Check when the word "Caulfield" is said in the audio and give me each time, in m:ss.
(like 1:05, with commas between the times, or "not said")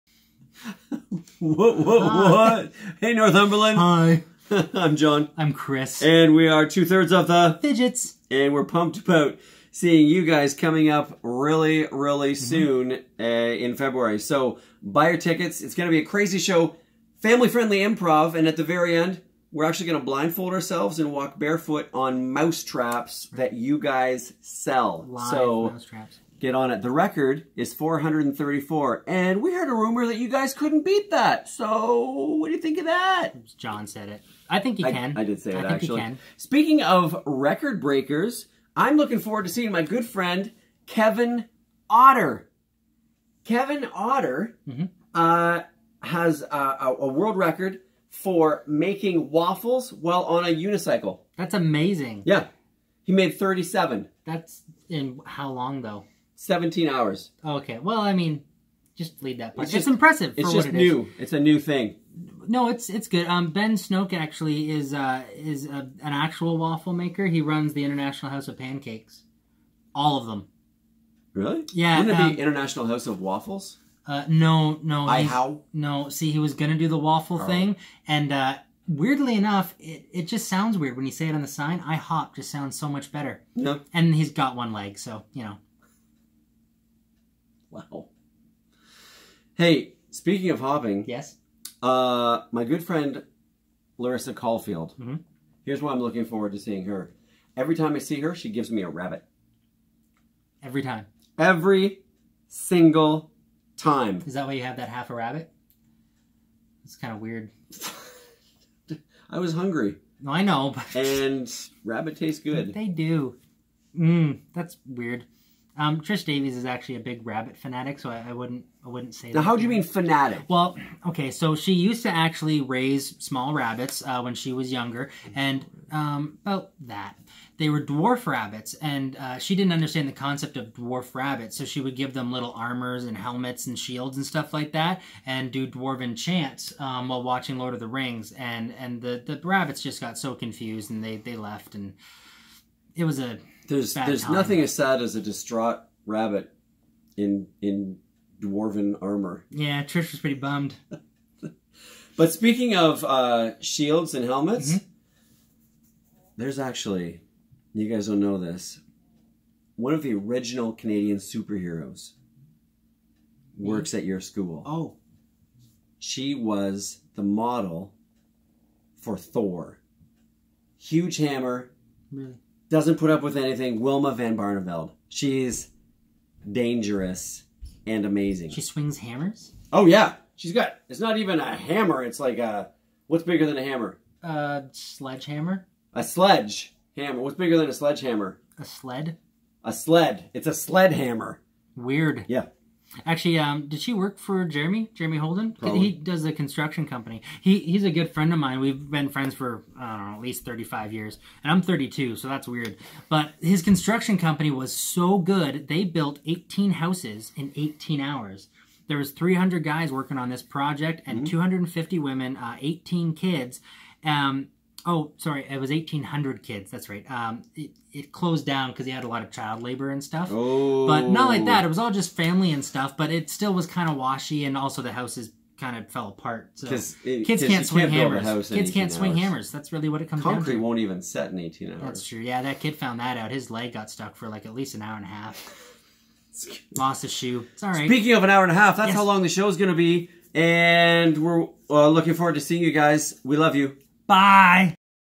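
1:34.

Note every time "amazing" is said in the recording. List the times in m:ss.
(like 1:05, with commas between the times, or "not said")
0:51, 2:58.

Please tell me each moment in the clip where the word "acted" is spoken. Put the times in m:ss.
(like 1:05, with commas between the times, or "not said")
not said.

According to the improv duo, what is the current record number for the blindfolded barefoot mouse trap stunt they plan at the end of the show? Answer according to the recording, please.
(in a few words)
434.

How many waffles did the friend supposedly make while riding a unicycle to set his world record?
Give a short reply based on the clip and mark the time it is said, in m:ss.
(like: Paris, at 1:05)
37, at 0:53.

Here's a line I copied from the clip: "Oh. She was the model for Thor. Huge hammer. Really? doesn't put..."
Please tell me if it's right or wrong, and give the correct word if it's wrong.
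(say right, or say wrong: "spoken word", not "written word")
right.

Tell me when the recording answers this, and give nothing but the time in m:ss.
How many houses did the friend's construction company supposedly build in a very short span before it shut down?
3:26.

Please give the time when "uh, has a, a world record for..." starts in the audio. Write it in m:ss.
0:45.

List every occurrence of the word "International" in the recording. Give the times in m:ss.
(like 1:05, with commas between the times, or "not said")
1:07, 1:12.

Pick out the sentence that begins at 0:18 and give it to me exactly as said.
And at the very end, we're actually going to blindfold ourselves and walk barefoot on mouse traps that you guys sell.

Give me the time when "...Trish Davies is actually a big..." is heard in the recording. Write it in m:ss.
1:56.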